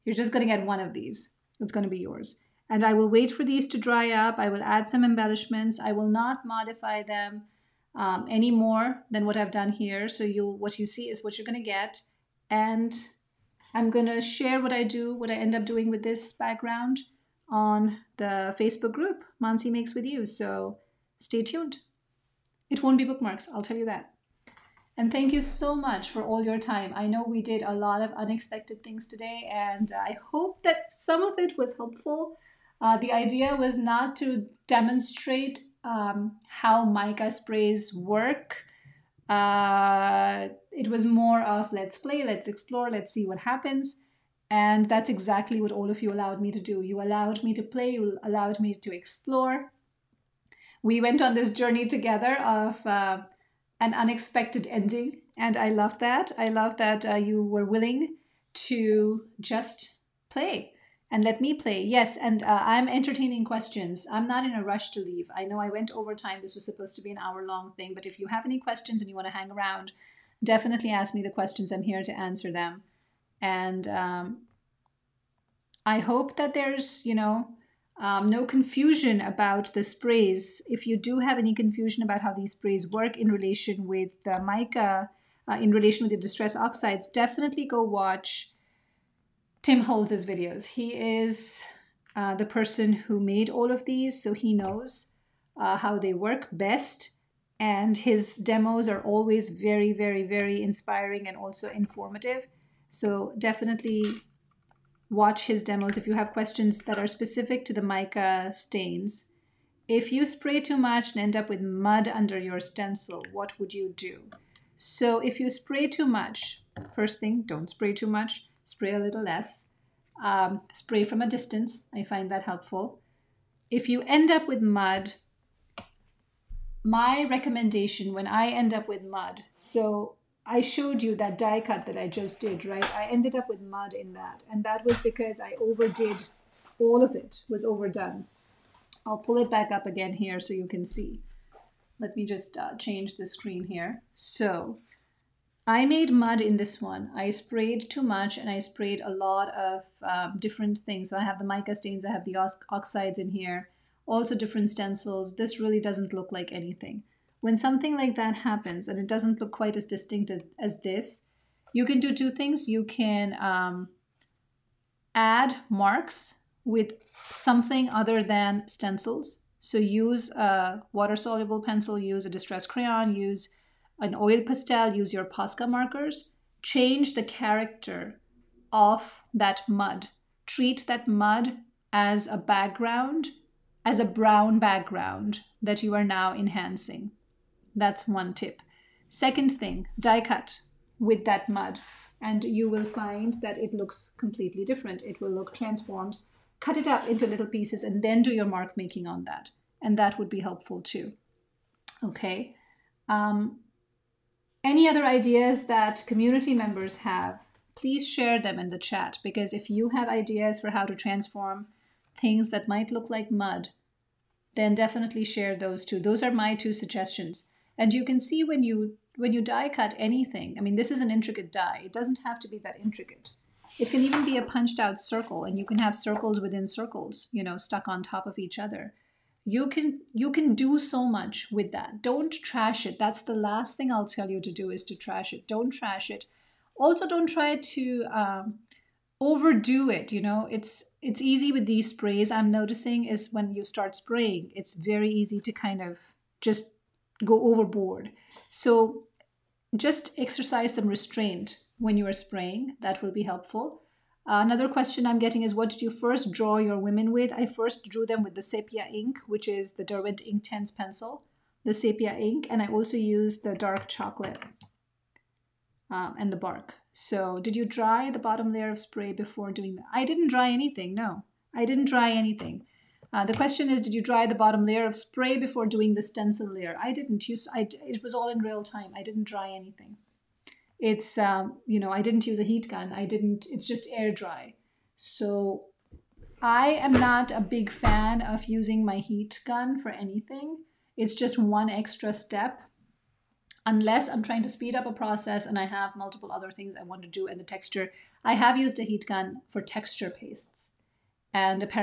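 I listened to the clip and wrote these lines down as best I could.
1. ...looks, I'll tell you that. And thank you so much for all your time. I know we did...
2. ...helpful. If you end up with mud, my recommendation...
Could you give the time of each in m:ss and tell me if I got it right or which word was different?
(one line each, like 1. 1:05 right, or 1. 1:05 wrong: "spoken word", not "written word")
1. 0:23 wrong: "bookmarks", not "looks"
2. 2:02 right.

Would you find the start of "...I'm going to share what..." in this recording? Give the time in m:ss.
0:13.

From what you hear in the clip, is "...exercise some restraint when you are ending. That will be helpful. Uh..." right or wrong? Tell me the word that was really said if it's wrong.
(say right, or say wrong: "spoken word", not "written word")
wrong: "spraying", not "ending".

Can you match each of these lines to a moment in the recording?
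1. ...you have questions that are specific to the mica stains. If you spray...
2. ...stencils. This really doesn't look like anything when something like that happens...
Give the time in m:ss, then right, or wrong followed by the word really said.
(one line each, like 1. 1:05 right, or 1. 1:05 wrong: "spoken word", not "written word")
1. 1:46 right
2. 2:34 right.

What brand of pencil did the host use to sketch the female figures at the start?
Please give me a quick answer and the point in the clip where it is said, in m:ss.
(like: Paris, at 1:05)
Derwent Inktense, at 4:19.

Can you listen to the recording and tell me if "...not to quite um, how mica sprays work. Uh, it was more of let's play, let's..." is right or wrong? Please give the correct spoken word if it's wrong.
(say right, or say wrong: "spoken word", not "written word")
wrong: "demonstrate", not "quite".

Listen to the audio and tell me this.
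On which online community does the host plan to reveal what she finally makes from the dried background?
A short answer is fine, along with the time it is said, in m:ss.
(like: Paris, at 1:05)
Mansi Makes With You, at 0:19.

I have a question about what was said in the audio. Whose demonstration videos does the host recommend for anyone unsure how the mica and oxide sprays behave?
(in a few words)
Tim Holtz.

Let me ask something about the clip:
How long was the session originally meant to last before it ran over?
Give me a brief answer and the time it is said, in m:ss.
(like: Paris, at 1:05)
an hour, at 1:07.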